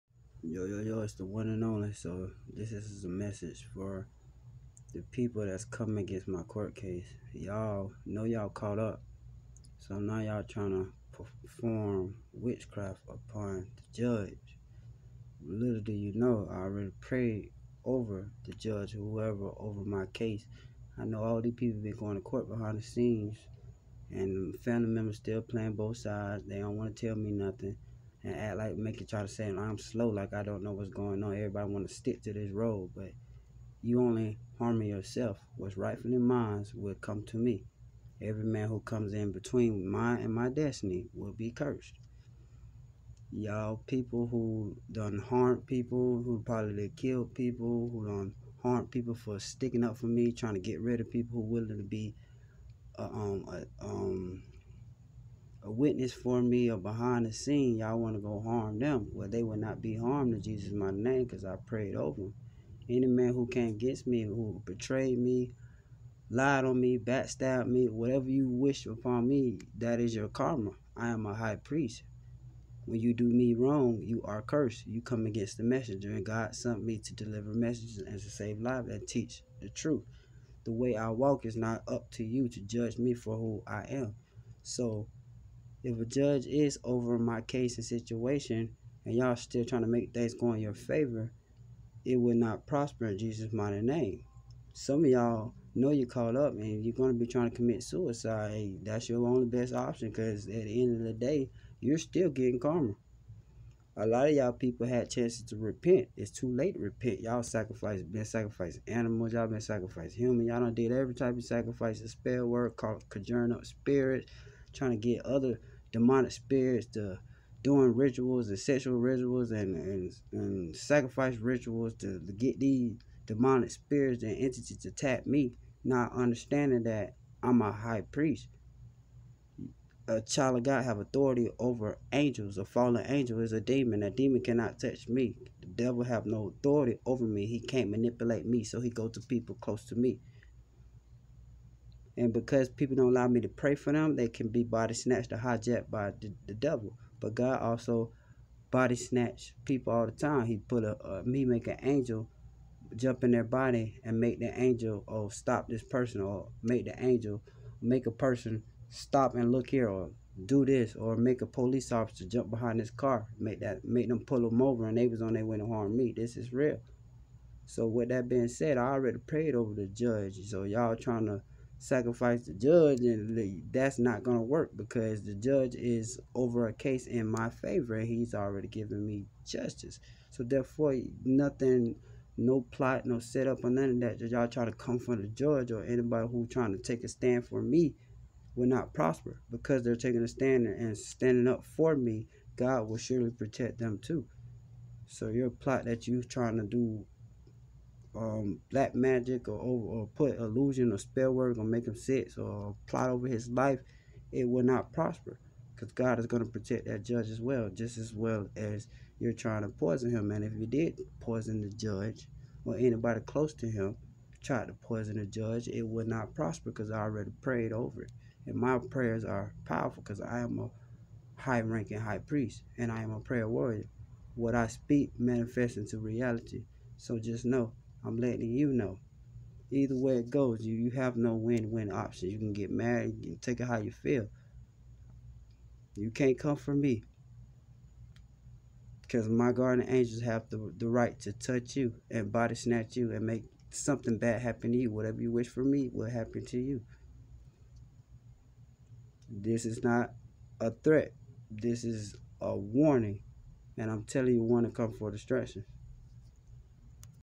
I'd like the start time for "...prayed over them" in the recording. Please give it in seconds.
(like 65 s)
61 s.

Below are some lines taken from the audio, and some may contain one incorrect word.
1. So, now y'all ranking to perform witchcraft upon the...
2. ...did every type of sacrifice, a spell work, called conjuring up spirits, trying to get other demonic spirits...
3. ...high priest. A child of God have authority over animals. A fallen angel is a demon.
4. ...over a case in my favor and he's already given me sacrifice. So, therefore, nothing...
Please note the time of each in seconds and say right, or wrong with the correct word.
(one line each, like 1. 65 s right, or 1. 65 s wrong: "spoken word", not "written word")
1. 9 s wrong: "trying", not "ranking"
2. 110 s right
3. 127 s wrong: "angels", not "animals"
4. 176 s wrong: "justice", not "sacrifice".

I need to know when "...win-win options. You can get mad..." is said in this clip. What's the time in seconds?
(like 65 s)
231 s.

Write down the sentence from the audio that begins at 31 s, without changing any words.
Everybody want to stick to this road, but you only harming yourself.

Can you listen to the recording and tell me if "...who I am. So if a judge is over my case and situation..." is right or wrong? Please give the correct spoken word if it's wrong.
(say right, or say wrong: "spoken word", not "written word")
right.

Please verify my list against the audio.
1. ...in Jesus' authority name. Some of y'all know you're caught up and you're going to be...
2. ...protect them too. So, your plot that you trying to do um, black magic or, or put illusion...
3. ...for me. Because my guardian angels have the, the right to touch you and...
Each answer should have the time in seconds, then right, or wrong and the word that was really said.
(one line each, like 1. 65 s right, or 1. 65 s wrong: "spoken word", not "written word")
1. 93 s wrong: "mighty", not "authority"
2. 193 s right
3. 236 s right.